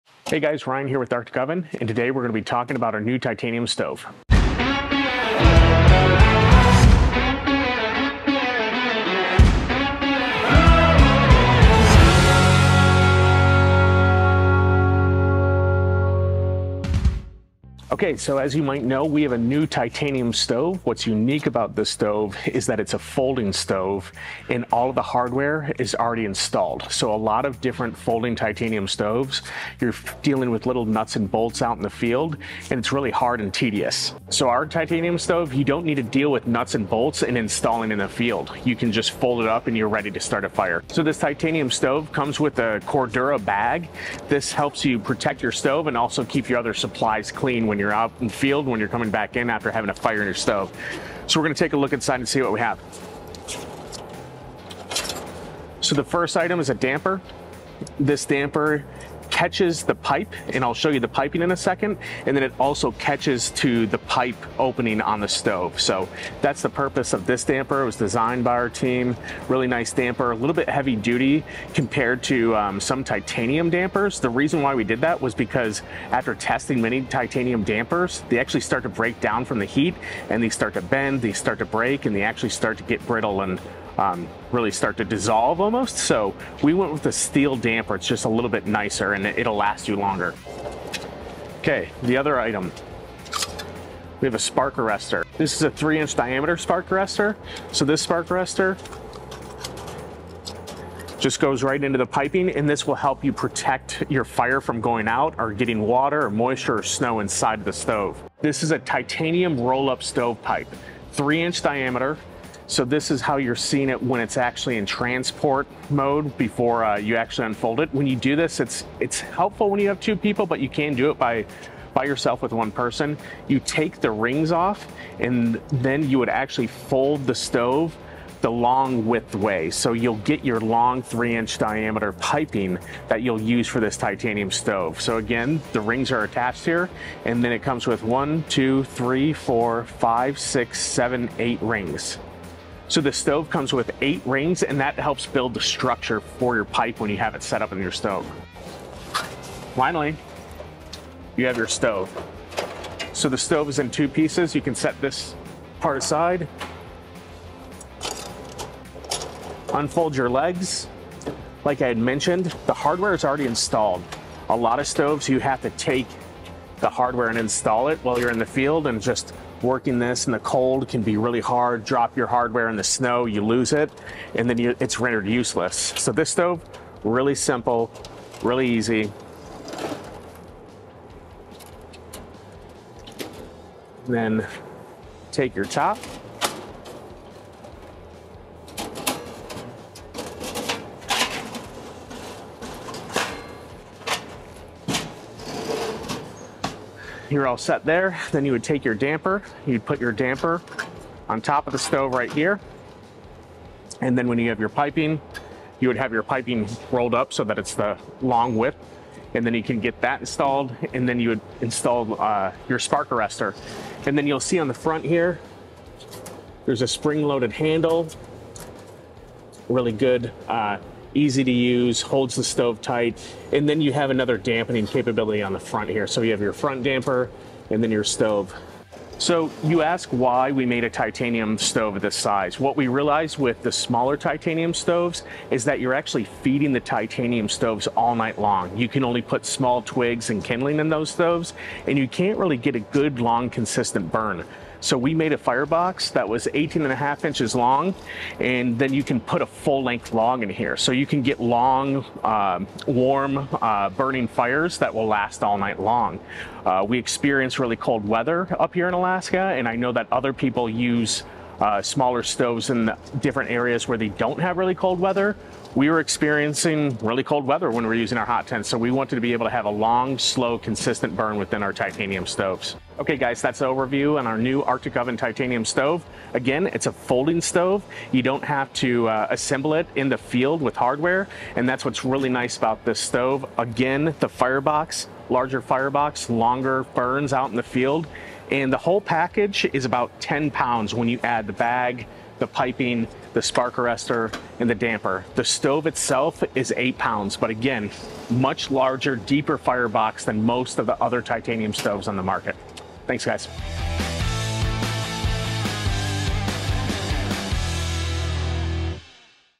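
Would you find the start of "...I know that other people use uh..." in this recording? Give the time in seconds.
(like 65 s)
259 s.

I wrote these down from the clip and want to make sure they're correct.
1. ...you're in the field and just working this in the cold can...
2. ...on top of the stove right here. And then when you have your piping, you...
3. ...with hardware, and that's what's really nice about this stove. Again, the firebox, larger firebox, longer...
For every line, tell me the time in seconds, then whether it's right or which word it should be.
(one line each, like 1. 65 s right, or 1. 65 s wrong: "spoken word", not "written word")
1. 168 s right
2. 201 s right
3. 280 s right.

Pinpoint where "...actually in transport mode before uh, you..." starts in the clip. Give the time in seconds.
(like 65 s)
114 s.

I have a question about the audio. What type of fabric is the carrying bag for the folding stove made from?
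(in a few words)
Cordura.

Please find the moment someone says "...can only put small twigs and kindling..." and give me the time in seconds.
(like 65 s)
238 s.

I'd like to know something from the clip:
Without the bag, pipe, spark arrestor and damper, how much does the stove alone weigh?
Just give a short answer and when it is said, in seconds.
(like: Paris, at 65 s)
8 pounds, at 296 s.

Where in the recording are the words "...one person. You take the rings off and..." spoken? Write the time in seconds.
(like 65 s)
122 s.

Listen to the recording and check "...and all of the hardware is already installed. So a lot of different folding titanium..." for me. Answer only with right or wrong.
right.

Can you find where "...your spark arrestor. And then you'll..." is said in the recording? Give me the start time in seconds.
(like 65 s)
212 s.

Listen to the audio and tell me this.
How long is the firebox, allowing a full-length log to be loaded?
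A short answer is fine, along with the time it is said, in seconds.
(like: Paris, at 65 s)
18.5 inches, at 246 s.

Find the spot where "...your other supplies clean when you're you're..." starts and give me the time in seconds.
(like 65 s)
46 s.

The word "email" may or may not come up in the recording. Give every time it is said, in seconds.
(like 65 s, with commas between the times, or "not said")
not said.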